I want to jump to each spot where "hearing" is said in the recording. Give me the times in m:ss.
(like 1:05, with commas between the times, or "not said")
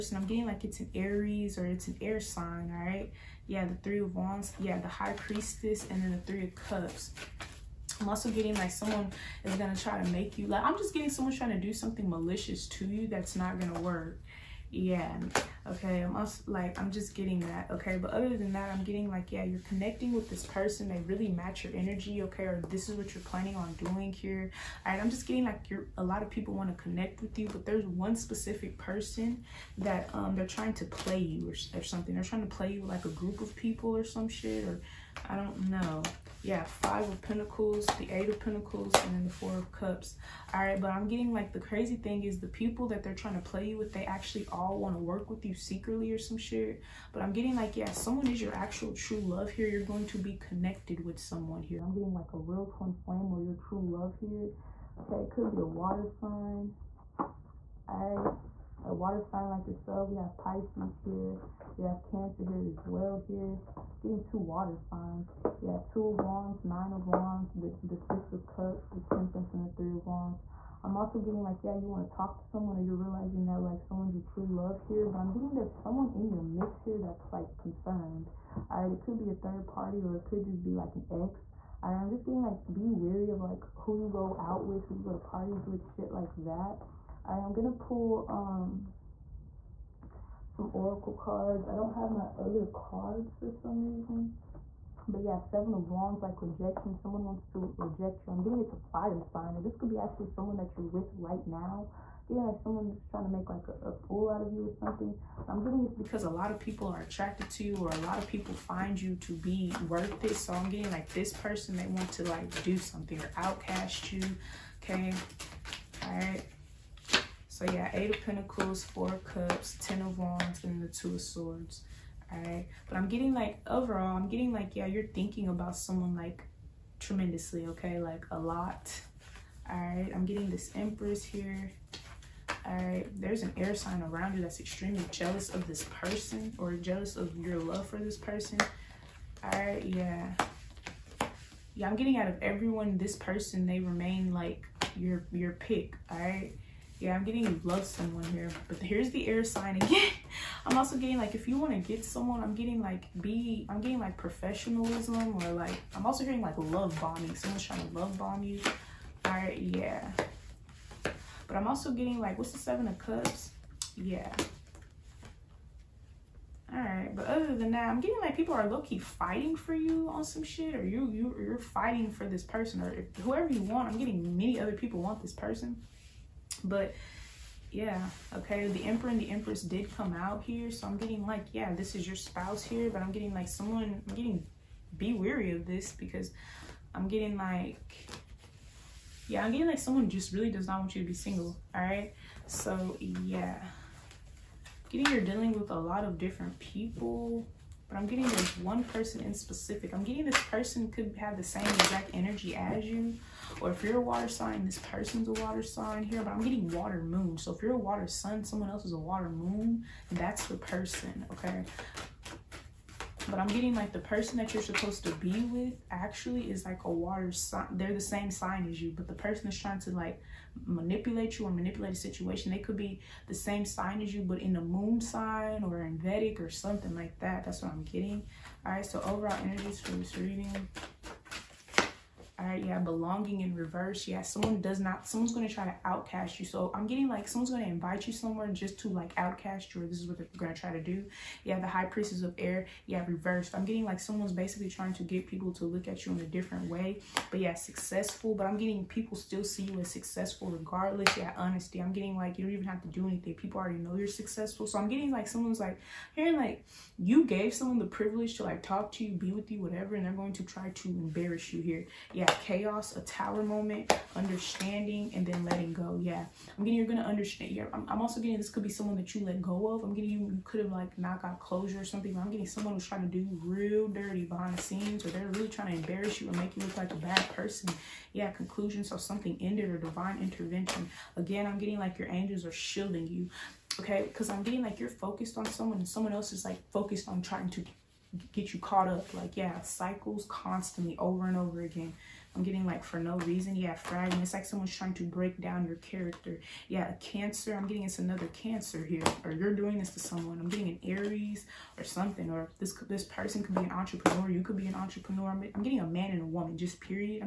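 4:16.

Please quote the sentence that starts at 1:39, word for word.
And this could be actually someone that you're with right now.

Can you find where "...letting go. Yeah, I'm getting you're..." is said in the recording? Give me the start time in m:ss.
4:25.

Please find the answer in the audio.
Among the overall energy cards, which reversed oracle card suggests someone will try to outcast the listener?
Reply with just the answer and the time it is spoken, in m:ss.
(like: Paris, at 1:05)
belonging, at 3:52.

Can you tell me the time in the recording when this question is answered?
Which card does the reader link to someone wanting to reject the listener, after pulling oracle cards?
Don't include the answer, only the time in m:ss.
1:35.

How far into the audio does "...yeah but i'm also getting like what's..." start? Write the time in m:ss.
2:39.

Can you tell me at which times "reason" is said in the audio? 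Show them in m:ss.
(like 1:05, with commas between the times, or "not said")
1:33, 4:53.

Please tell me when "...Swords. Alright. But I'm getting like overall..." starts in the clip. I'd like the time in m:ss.
2:01.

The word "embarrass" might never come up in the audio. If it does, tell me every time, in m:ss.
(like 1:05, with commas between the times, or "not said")
4:20, 4:35.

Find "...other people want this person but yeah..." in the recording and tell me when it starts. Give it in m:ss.
2:54.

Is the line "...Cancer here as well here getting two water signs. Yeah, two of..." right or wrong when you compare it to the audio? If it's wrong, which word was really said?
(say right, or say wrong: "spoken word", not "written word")
right.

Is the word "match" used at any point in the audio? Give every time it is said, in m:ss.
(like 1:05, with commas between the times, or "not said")
0:21.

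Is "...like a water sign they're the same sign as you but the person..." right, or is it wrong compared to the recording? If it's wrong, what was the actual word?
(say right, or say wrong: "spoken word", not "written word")
right.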